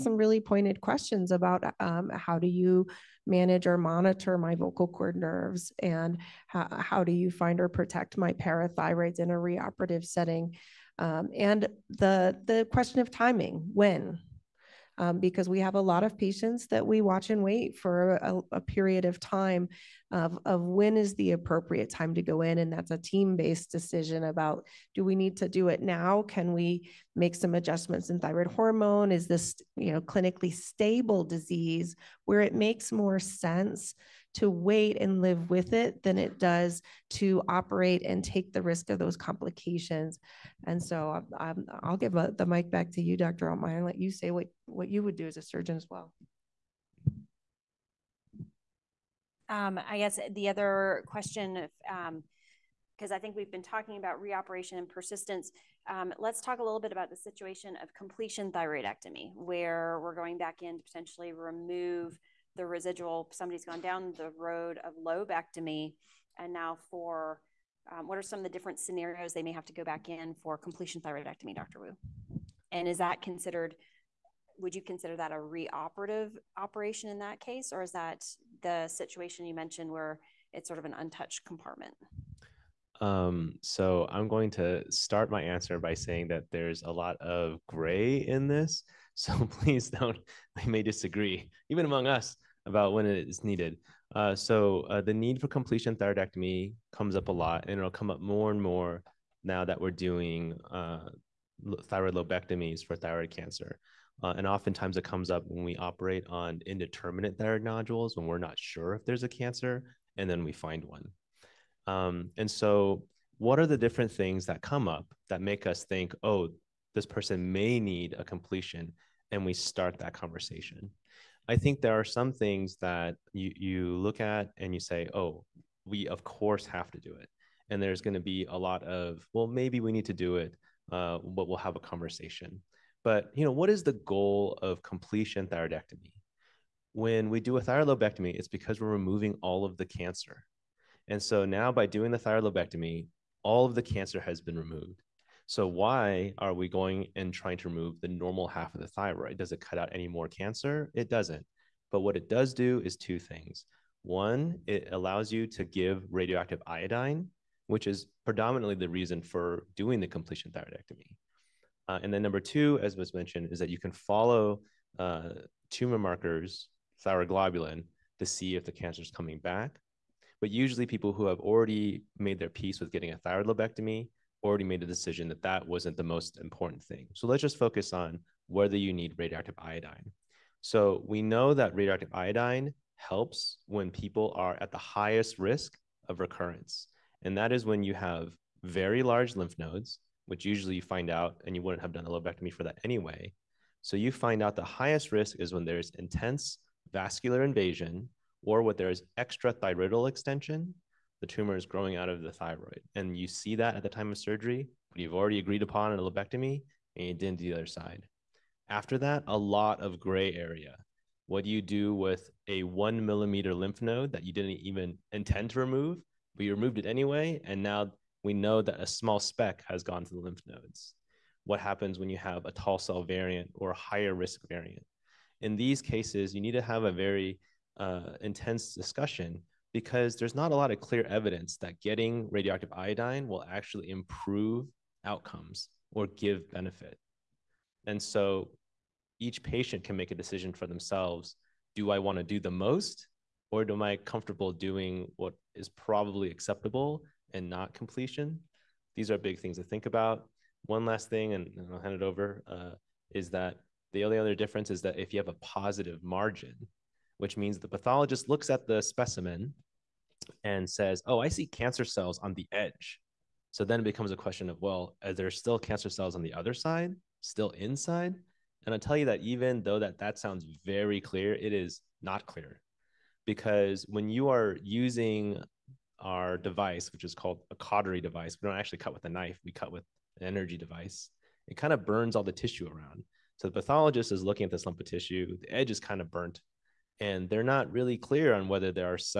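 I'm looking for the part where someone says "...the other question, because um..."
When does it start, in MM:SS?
00:50.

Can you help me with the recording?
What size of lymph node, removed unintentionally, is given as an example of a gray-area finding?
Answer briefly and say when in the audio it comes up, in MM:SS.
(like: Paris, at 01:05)
1 millimeter, at 03:32.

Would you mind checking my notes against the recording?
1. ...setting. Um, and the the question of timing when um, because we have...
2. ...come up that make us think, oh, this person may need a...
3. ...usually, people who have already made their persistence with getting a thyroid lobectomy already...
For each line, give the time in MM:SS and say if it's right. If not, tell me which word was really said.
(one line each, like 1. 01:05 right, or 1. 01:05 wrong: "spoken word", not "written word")
1. 00:10 right
2. 01:54 right
3. 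02:50 wrong: "peace", not "persistence".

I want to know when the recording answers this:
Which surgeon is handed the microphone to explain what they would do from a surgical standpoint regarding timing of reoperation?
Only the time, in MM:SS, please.
00:43.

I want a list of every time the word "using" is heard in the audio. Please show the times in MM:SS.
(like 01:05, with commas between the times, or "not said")
04:34.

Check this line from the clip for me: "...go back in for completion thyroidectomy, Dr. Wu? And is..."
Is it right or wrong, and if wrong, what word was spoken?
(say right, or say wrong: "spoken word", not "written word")
right.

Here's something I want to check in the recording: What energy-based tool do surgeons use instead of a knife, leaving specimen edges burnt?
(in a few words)
Cautery device.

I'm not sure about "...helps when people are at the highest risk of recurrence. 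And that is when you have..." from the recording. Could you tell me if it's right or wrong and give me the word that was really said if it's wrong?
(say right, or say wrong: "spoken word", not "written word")
right.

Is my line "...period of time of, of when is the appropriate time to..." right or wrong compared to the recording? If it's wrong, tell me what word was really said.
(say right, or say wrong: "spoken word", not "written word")
right.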